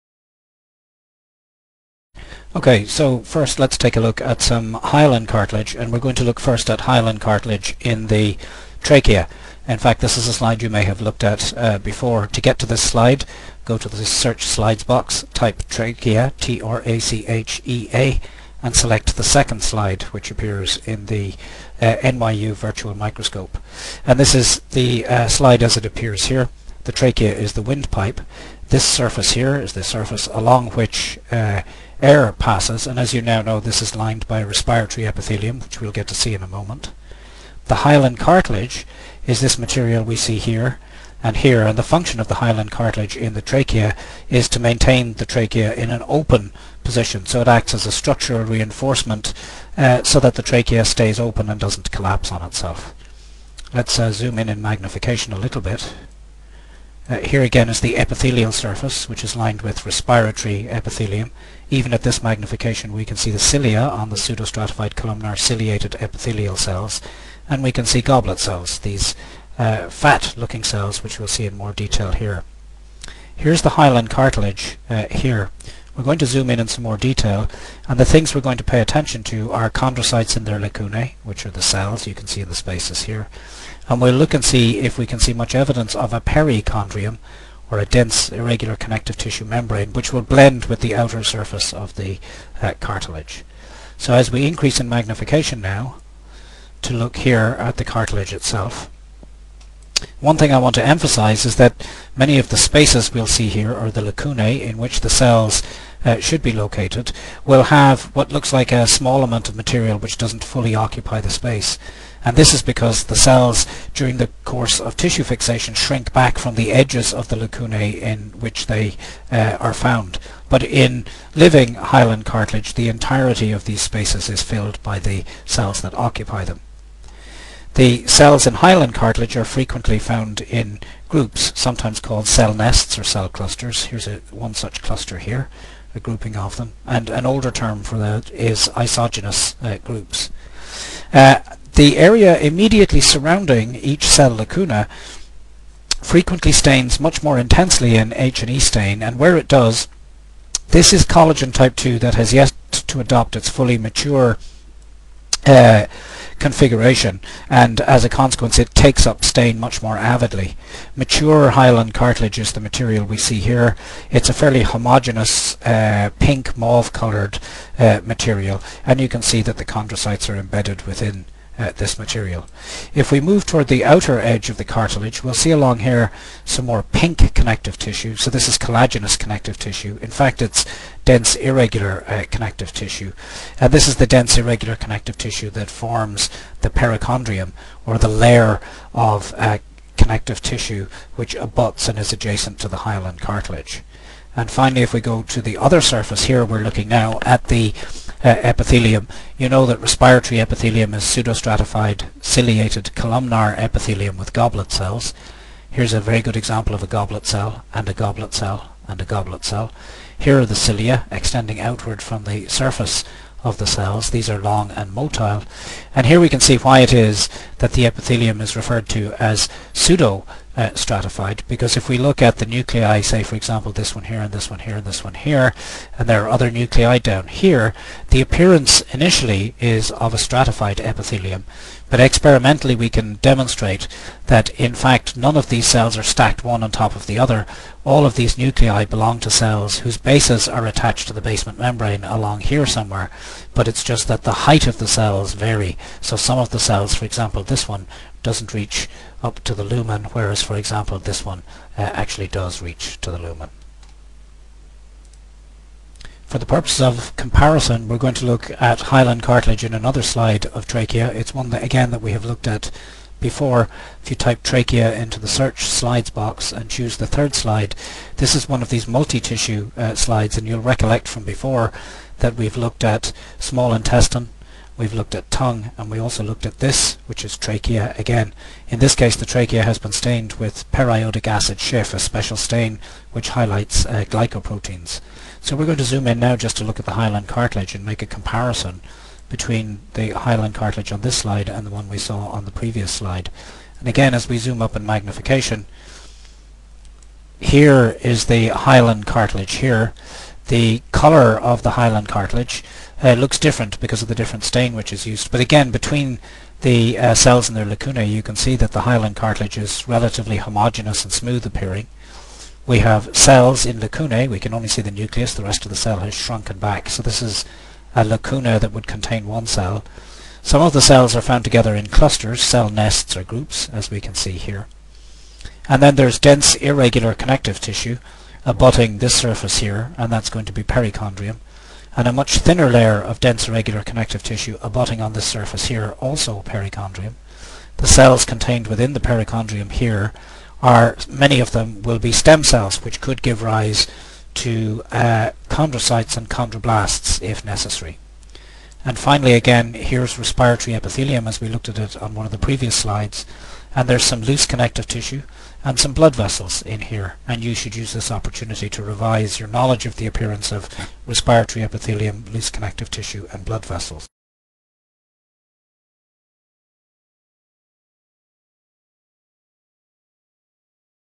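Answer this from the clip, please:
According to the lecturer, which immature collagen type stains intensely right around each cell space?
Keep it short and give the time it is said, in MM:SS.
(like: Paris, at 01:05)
collagen type 2, at 02:31.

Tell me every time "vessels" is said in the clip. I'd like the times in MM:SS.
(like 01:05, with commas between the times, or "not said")
05:56, 06:03.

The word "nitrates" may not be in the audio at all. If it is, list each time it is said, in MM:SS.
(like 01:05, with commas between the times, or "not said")
not said.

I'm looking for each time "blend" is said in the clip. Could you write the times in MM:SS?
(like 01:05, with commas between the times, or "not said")
01:30.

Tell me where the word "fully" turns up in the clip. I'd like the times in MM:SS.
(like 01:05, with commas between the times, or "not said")
01:50, 02:33.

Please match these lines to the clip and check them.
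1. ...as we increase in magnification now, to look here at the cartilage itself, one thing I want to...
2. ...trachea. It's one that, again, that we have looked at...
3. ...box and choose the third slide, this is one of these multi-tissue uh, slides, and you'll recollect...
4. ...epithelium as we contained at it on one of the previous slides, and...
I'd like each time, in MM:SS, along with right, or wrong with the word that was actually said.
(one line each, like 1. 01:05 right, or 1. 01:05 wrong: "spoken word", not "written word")
1. 01:34 right
2. 04:20 right
3. 04:26 right
4. 05:50 wrong: "looked", not "contained".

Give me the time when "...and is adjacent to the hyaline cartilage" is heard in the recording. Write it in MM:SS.
03:11.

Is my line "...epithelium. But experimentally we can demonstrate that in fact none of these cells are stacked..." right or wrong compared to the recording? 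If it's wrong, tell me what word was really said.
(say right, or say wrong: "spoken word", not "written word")
right.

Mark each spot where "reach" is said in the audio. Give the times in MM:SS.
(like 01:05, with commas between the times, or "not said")
04:08, 04:12.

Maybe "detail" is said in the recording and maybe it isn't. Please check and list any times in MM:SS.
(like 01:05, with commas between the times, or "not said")
01:11, 01:16.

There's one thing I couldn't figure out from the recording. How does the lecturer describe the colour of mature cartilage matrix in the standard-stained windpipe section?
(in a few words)
pink mauve.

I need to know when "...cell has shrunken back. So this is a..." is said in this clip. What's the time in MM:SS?
05:15.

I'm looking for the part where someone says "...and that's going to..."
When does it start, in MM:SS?
05:29.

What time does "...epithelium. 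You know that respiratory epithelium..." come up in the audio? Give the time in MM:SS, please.
03:18.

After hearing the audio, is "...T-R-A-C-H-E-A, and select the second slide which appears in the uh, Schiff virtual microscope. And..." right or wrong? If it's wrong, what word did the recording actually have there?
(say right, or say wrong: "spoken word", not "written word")
wrong: "NYU", not "Schiff".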